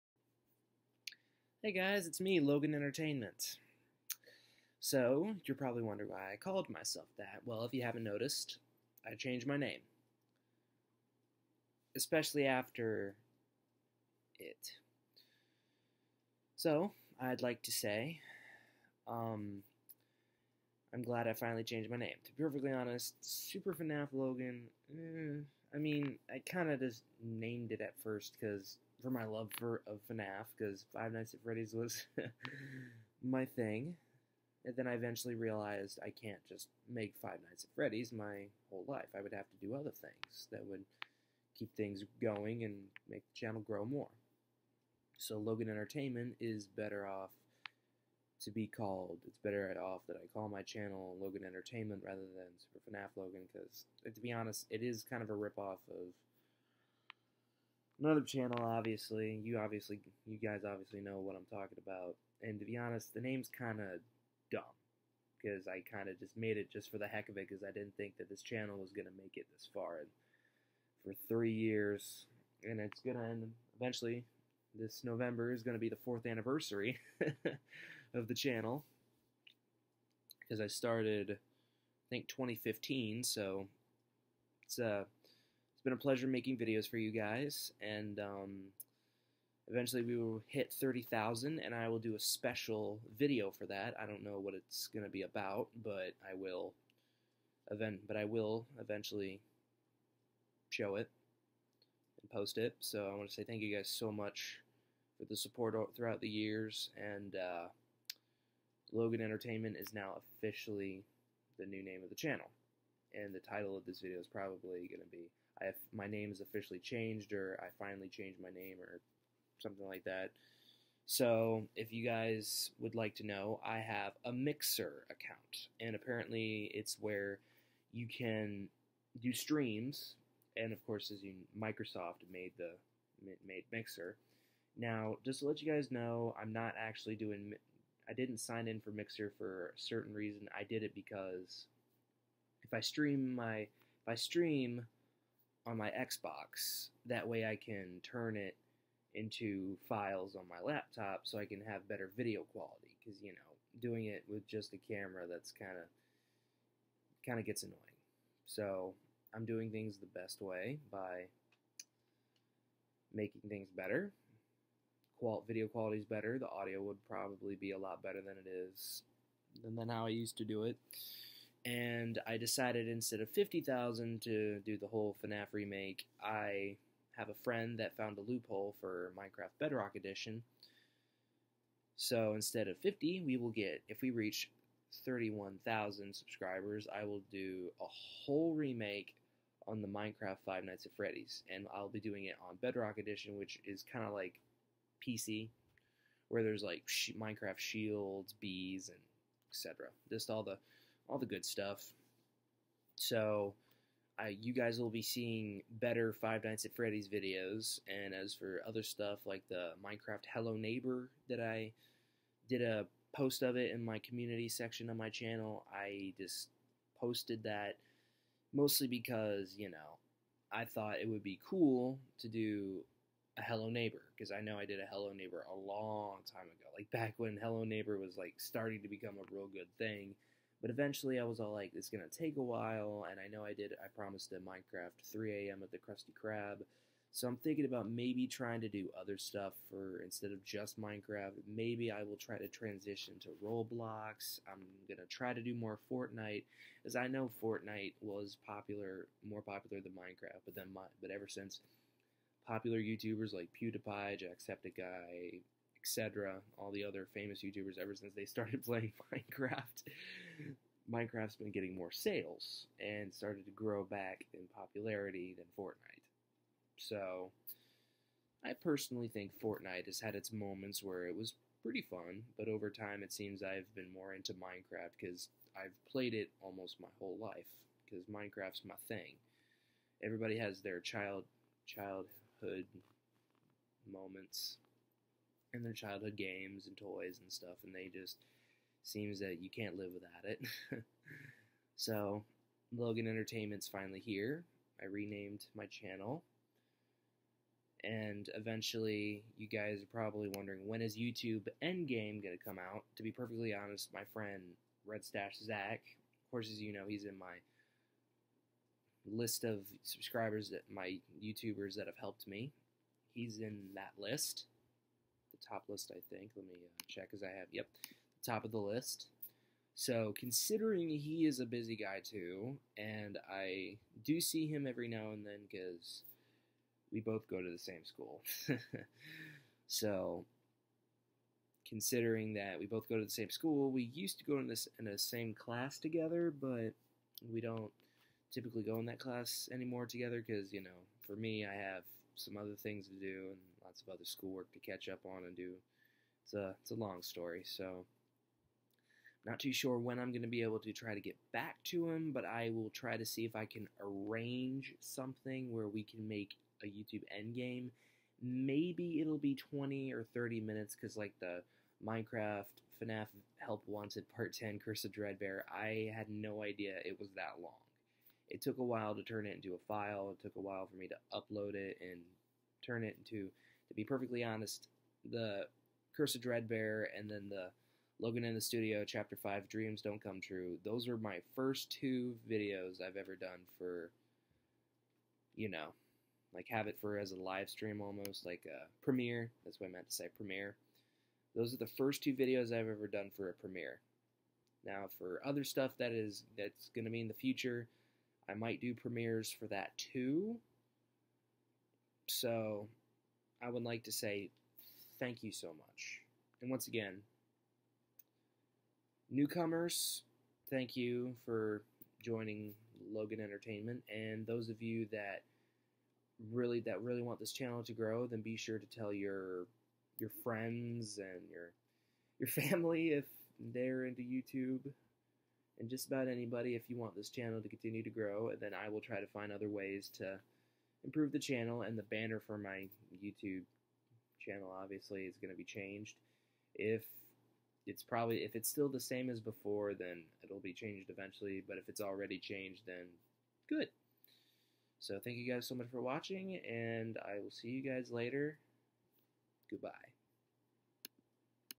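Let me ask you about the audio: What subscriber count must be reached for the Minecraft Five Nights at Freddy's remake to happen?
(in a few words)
31,000.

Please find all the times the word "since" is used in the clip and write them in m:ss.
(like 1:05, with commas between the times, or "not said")
4:11, 4:17.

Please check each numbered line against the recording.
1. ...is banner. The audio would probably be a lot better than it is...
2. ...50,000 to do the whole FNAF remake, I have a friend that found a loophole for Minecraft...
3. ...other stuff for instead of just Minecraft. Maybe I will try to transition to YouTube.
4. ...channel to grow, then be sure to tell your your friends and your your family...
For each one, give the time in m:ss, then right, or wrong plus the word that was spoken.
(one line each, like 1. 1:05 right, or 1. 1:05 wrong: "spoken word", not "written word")
1. 2:45 wrong: "better", not "banner"
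2. 2:53 right
3. 3:58 wrong: "Roblox", not "YouTube"
4. 6:57 right.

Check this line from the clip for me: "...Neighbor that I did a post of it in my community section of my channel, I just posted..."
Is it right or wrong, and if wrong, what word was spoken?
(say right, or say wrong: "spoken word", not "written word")
right.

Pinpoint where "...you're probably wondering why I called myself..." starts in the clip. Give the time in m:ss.
0:05.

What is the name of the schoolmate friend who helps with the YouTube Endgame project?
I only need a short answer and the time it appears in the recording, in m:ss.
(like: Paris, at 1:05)
Red Stash Zach, at 5:04.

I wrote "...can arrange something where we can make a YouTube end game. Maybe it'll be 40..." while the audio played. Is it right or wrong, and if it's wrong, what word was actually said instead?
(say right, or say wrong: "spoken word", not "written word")
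wrong: "20", not "40".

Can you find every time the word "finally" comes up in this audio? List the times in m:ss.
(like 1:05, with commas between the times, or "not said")
0:21, 1:57, 4:53.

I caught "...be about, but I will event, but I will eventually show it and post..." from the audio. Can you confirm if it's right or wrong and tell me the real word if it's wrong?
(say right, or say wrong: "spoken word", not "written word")
right.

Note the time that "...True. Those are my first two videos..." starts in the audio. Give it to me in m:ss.
6:20.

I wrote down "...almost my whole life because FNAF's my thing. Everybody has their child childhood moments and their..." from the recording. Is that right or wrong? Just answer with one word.
wrong.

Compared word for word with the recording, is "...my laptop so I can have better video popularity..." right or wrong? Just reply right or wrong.
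wrong.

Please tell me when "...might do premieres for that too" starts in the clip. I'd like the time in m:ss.
6:38.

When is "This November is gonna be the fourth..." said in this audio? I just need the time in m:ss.
1:14.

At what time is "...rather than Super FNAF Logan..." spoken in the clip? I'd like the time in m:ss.
0:52.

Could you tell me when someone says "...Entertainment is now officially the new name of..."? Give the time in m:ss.
1:49.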